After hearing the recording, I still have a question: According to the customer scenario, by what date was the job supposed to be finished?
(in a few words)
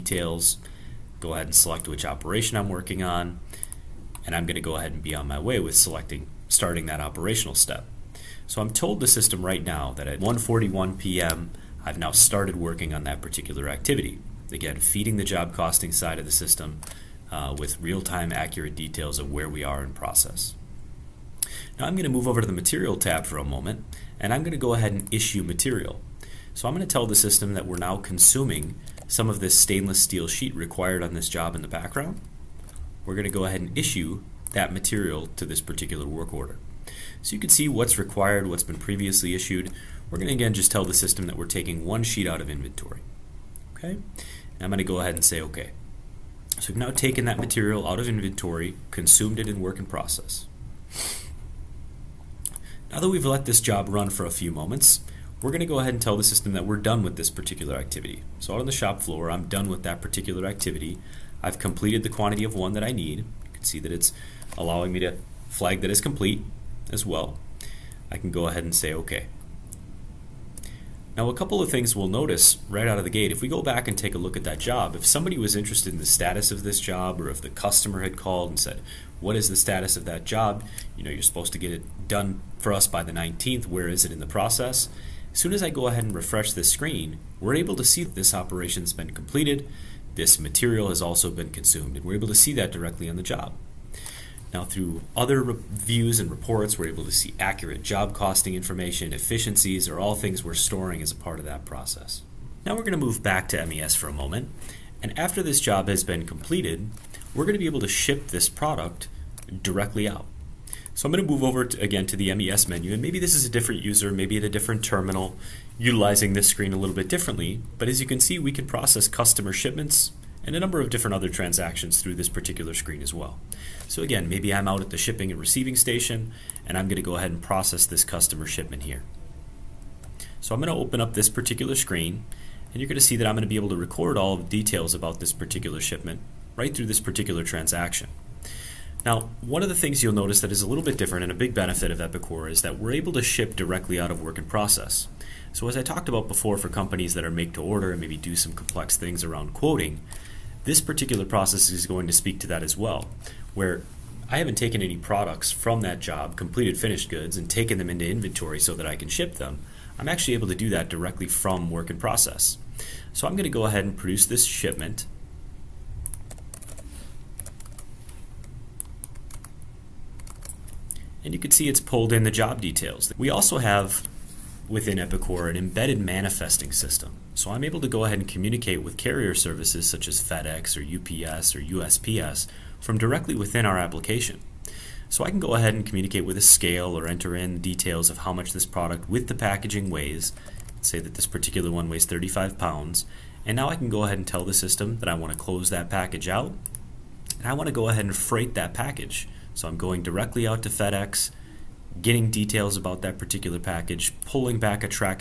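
The 19th.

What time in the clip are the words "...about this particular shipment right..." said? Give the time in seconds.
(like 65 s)
134 s.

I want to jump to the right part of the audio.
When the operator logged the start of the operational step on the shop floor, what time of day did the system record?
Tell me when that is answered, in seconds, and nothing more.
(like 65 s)
10 s.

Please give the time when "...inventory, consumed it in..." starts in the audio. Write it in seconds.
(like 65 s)
48 s.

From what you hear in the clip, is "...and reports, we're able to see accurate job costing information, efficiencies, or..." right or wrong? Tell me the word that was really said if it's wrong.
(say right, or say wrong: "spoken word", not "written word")
right.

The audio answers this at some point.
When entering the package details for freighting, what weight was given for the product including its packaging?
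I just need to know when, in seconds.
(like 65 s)
192 s.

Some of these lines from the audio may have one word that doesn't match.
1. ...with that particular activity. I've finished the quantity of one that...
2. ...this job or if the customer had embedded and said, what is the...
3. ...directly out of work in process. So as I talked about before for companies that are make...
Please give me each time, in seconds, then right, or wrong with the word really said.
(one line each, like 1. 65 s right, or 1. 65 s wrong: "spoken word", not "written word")
1. 59 s wrong: "completed", not "finished"
2. 76 s wrong: "called", not "embedded"
3. 143 s right.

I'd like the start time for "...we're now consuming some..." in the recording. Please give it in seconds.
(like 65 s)
27 s.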